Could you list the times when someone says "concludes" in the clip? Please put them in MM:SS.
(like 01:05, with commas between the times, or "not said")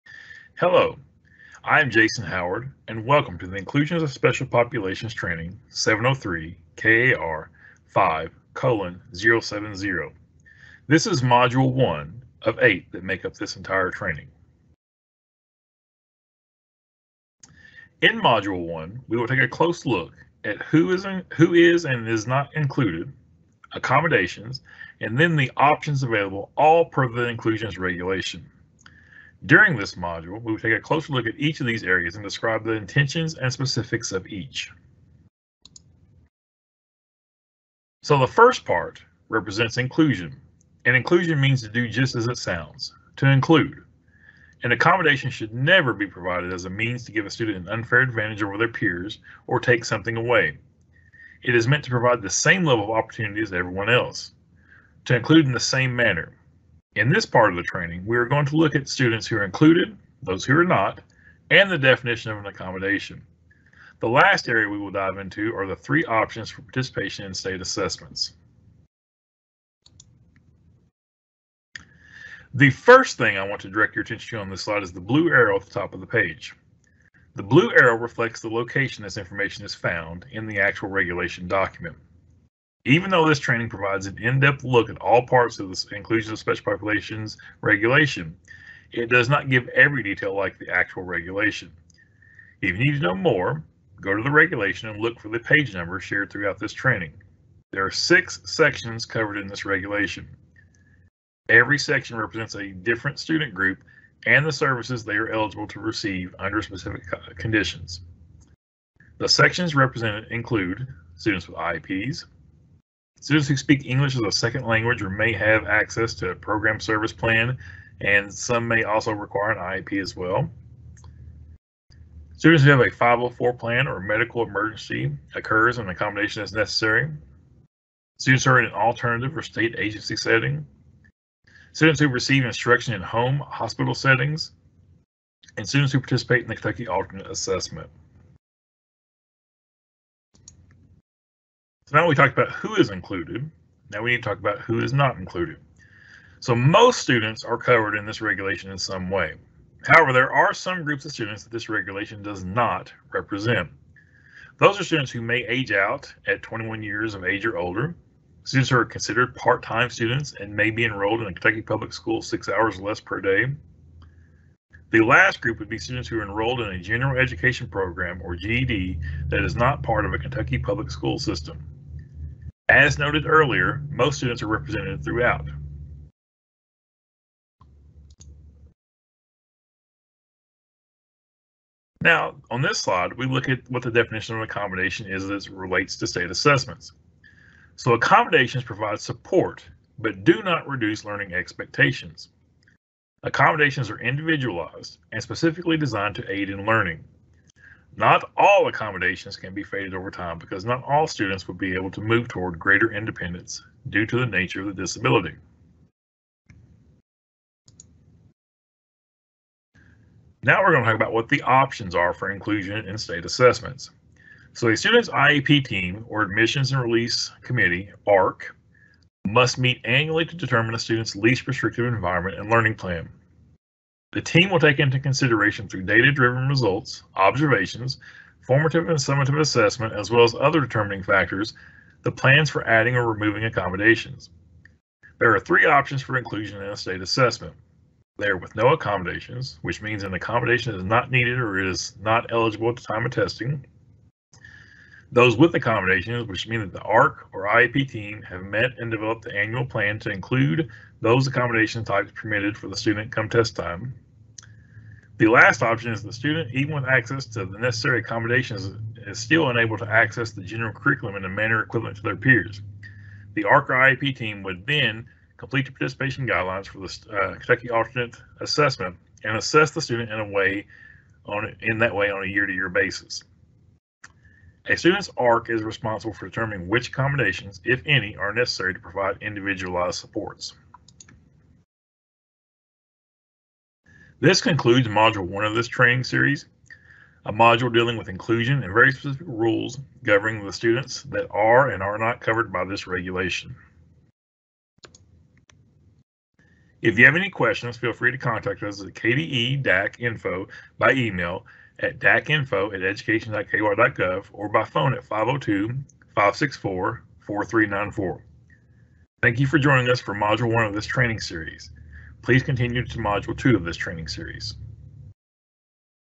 04:44.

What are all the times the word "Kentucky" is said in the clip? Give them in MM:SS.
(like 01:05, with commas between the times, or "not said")
02:16, 02:41, 02:50, 04:27.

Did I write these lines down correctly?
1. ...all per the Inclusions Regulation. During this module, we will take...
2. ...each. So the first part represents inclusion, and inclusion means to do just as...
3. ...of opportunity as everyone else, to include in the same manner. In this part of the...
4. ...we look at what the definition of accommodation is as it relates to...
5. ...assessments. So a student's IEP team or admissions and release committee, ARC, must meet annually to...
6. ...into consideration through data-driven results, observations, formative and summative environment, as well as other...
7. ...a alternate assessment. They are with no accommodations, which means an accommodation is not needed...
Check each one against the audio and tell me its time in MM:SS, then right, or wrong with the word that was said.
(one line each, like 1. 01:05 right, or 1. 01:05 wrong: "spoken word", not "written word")
1. 00:26 right
2. 00:34 right
3. 00:52 right
4. 03:03 right
5. 03:33 right
6. 03:44 wrong: "assessment", not "environment"
7. 03:56 wrong: "state", not "alternate".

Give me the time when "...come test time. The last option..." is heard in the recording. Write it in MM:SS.
04:13.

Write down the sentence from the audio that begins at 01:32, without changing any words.
If you need to know more, go to the regulation and look for the page number shared throughout this training.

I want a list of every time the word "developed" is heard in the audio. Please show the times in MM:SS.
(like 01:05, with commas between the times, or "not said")
04:08.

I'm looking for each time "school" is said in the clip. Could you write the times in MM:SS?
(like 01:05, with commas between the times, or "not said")
02:41, 02:50.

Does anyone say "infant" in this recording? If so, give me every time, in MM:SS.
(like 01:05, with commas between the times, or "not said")
not said.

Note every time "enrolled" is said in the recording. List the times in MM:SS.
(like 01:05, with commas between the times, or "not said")
02:40, 02:46.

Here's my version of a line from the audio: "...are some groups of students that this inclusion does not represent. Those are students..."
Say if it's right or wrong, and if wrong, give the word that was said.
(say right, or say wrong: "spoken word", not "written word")
wrong: "regulation", not "inclusion".